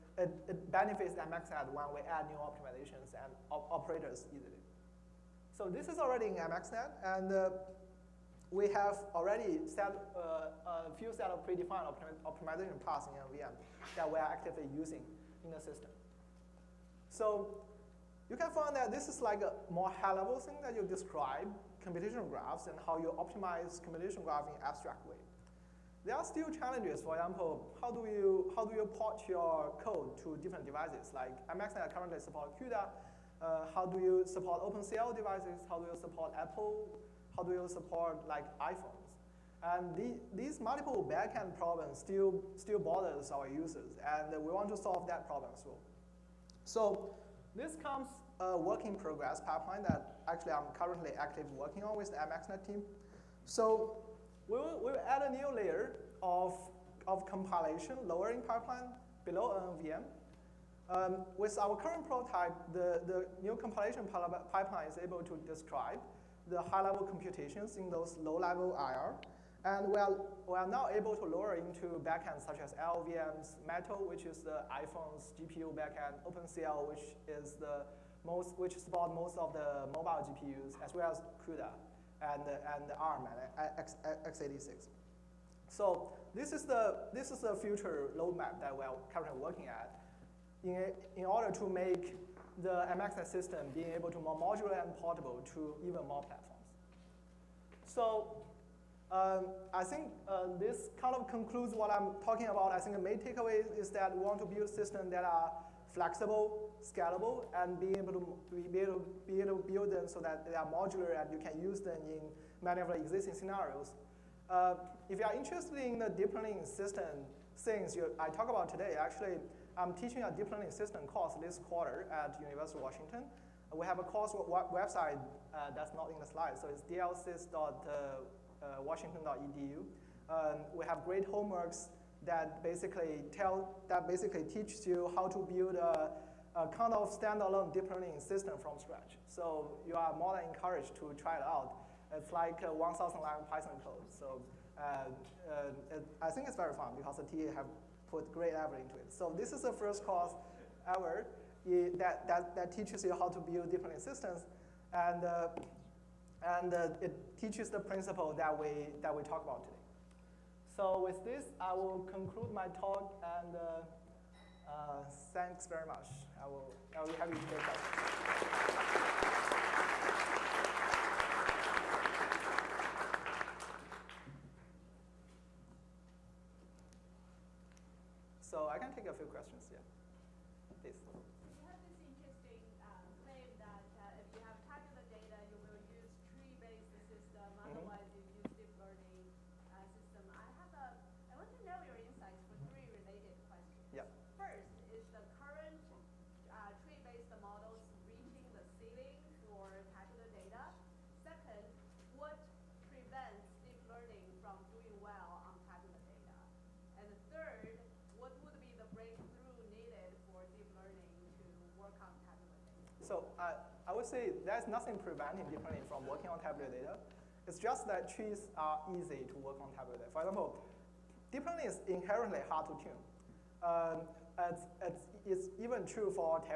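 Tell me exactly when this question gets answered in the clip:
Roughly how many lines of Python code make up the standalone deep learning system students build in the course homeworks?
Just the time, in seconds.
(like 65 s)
142 s.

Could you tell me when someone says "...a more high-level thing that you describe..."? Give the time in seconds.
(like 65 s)
19 s.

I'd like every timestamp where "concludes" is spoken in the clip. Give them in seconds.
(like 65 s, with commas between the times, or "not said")
101 s, 162 s.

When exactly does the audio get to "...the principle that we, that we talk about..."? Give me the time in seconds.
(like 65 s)
157 s.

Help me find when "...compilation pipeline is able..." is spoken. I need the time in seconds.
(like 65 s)
63 s.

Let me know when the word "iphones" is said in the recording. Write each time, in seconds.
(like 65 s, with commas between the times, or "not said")
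38 s, 74 s.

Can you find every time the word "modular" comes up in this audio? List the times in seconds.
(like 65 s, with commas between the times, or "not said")
94 s, 110 s.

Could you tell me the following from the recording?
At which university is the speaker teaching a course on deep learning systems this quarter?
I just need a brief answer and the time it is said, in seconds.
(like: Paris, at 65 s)
University of Washington, at 122 s.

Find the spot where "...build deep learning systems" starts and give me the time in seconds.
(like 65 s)
153 s.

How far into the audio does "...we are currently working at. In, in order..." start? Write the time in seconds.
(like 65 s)
88 s.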